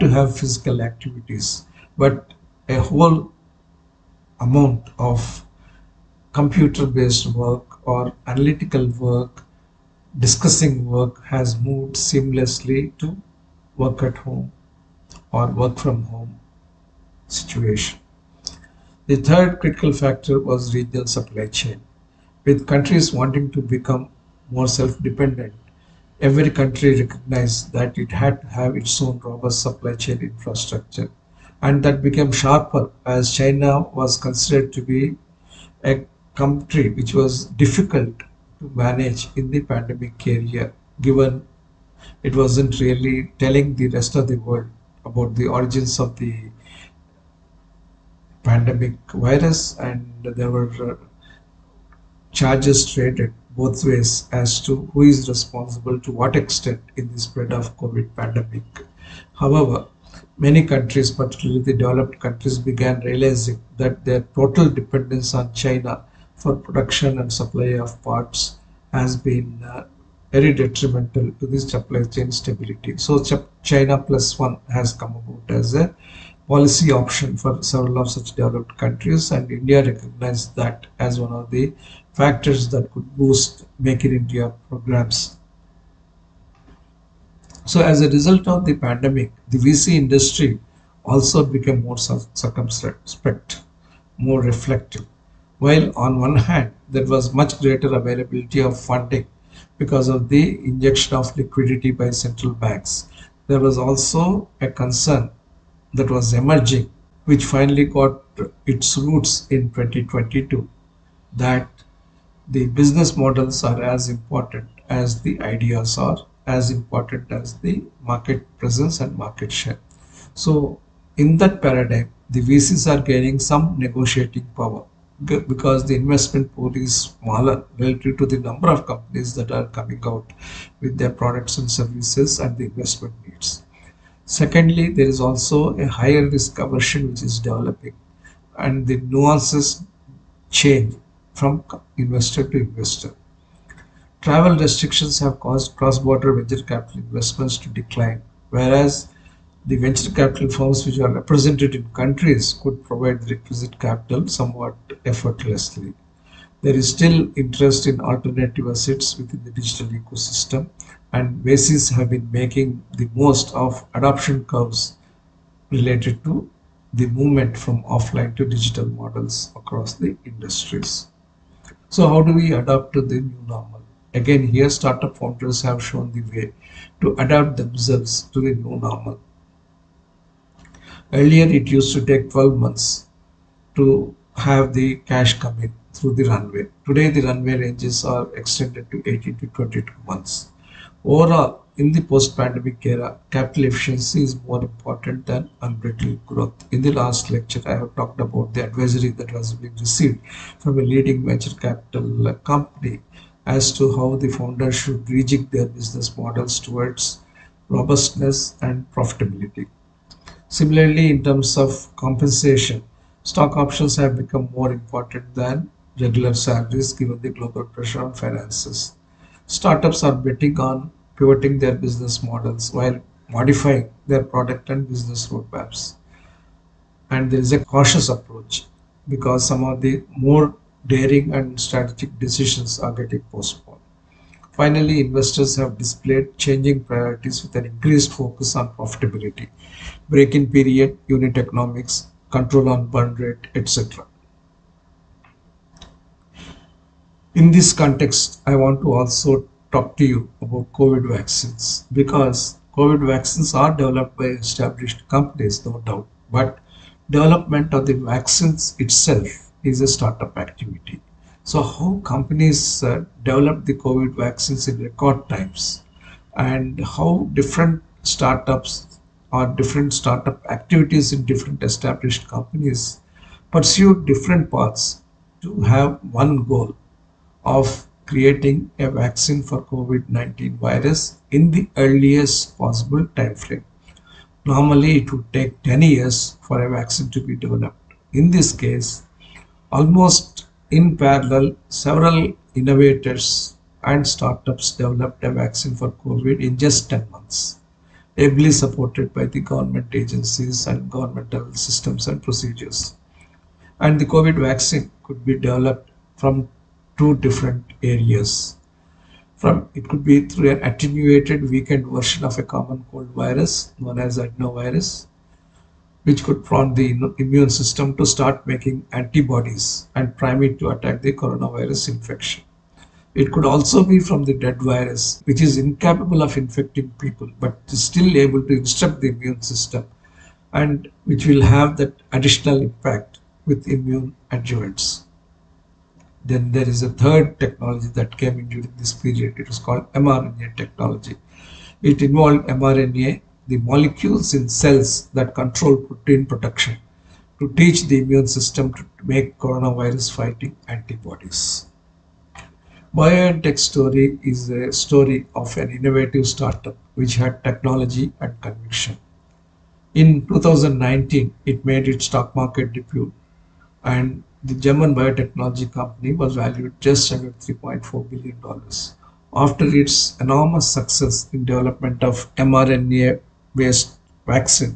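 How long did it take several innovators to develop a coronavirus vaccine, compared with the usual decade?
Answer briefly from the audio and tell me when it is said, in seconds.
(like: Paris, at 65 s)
10 months, at 296 s.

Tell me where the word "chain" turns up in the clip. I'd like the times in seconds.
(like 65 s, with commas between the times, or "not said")
21 s, 29 s, 72 s.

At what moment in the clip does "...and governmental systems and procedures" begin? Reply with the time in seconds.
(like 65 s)
300 s.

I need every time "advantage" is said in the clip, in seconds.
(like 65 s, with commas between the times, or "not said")
not said.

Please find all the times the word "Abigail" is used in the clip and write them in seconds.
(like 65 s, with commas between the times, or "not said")
not said.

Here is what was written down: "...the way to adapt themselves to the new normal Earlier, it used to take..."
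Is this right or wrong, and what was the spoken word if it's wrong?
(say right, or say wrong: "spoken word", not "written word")
right.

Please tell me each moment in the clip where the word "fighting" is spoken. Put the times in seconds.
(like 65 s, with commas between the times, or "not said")
350 s.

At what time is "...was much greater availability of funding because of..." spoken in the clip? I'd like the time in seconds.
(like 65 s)
97 s.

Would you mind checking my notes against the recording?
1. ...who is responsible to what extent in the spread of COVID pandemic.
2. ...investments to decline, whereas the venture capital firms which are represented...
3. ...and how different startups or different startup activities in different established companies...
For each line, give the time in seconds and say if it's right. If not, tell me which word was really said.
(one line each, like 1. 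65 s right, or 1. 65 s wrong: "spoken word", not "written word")
1. 54 s right
2. 147 s right
3. 266 s right.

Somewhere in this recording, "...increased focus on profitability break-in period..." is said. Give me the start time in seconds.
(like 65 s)
237 s.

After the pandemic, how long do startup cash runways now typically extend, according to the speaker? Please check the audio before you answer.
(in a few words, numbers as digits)
18 to 22 months.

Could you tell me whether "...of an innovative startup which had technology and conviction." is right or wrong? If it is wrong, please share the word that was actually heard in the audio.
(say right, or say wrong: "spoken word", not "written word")
right.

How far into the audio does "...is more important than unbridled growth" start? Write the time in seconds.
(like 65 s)
194 s.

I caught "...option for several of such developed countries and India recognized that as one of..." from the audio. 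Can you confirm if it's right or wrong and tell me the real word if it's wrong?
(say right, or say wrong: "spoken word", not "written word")
right.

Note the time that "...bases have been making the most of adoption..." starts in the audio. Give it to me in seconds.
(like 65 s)
161 s.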